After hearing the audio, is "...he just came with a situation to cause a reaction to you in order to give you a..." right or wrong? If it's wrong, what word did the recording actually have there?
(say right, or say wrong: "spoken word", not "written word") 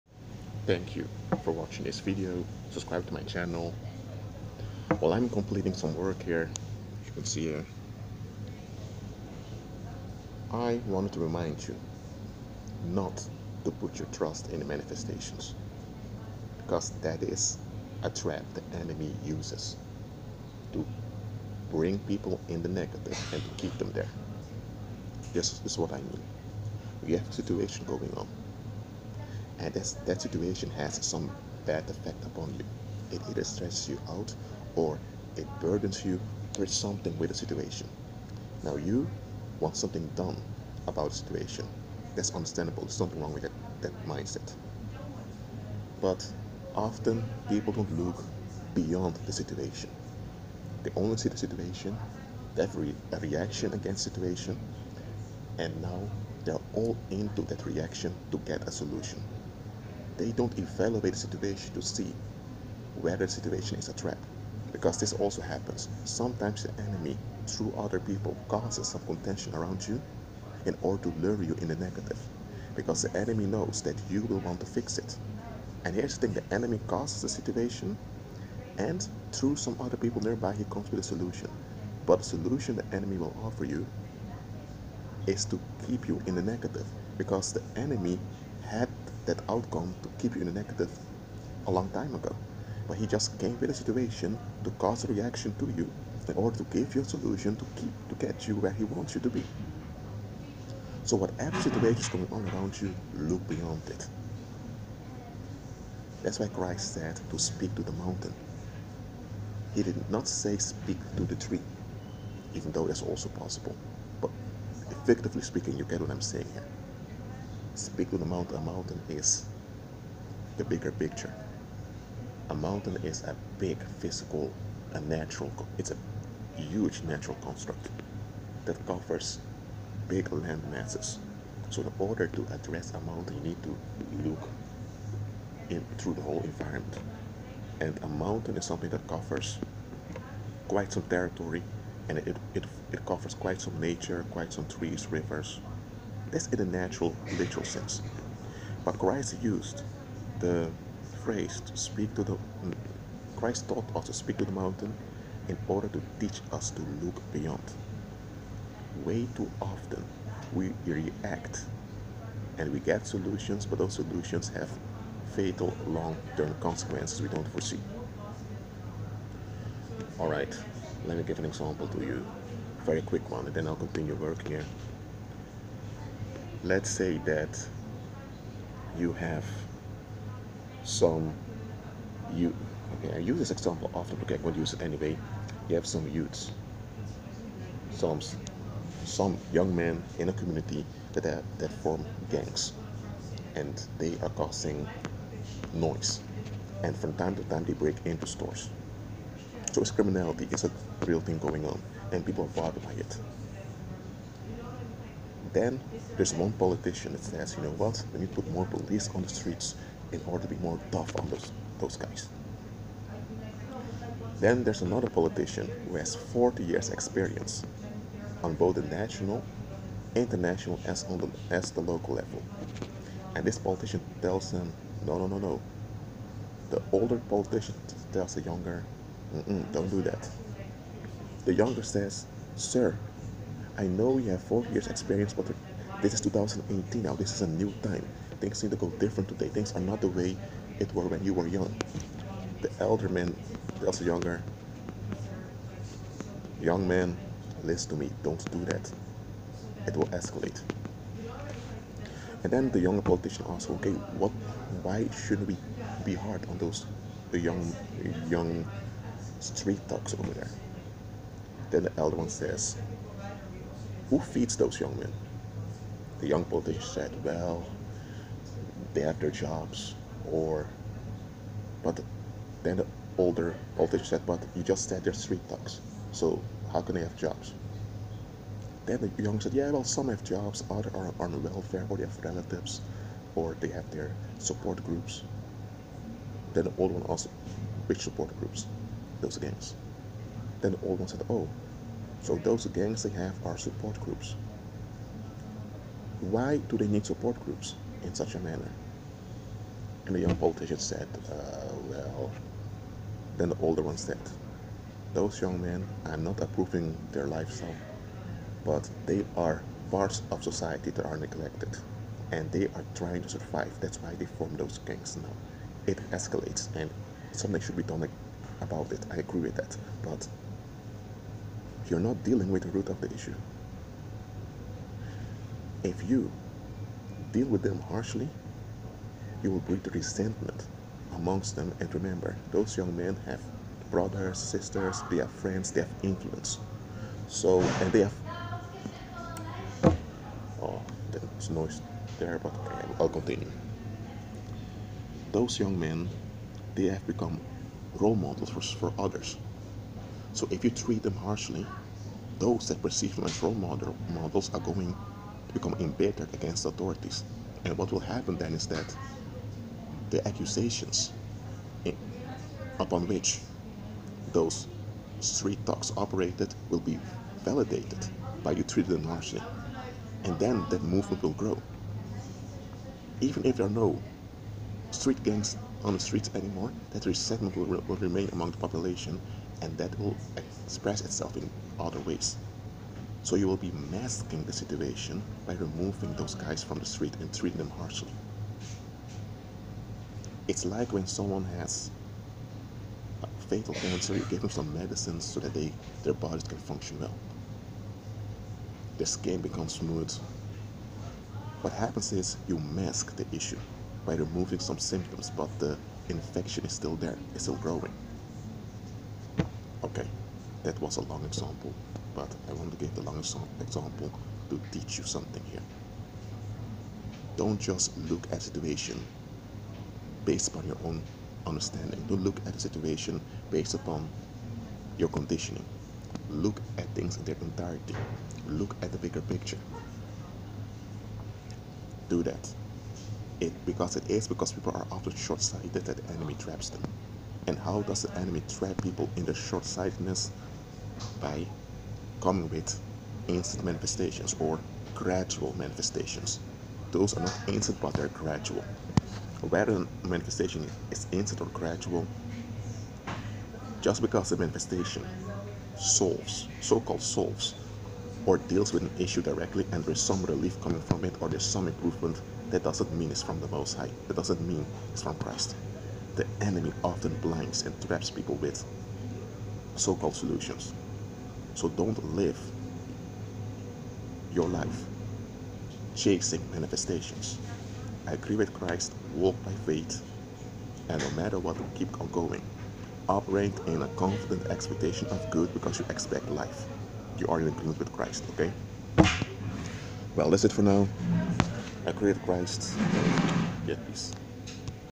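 right.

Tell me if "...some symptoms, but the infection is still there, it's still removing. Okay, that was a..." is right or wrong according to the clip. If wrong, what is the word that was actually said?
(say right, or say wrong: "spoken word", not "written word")
wrong: "growing", not "removing".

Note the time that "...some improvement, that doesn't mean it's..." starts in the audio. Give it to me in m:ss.
7:41.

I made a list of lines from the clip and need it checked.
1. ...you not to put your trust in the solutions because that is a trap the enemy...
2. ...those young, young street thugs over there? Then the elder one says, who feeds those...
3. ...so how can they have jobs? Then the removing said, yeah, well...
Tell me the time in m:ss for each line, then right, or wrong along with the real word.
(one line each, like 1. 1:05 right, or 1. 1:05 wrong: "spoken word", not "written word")
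1. 0:11 wrong: "manifestations", not "solutions"
2. 4:16 right
3. 4:36 wrong: "young", not "removing".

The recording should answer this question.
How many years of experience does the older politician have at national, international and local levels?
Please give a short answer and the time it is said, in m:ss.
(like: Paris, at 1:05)
40, at 3:36.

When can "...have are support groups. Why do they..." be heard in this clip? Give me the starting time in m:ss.
4:53.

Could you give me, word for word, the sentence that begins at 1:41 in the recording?
So whatever situation is going on around you, look beyond it.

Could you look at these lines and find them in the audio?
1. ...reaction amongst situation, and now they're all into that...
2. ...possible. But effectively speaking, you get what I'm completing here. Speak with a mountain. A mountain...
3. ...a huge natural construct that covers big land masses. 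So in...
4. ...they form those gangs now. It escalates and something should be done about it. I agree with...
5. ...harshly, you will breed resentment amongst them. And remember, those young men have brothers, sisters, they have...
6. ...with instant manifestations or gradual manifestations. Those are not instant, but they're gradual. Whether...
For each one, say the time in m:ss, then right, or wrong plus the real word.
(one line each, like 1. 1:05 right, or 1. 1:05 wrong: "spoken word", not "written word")
1. 0:53 wrong: "against", not "amongst"
2. 1:53 wrong: "saying", not "completing"
3. 2:05 right
4. 5:14 right
5. 5:27 right
6. 7:22 right.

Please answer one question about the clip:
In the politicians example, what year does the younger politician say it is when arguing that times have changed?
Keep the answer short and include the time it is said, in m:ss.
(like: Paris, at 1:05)
2018, at 3:56.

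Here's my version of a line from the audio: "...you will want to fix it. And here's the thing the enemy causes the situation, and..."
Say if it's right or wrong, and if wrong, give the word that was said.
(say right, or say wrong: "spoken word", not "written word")
right.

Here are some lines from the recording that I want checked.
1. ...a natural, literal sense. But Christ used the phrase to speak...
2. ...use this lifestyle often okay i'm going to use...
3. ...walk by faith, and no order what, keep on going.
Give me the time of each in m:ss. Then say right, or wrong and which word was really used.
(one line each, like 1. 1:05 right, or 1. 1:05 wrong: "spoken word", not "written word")
1. 2:26 right
2. 3:03 wrong: "example", not "lifestyle"
3. 7:59 wrong: "matter", not "order".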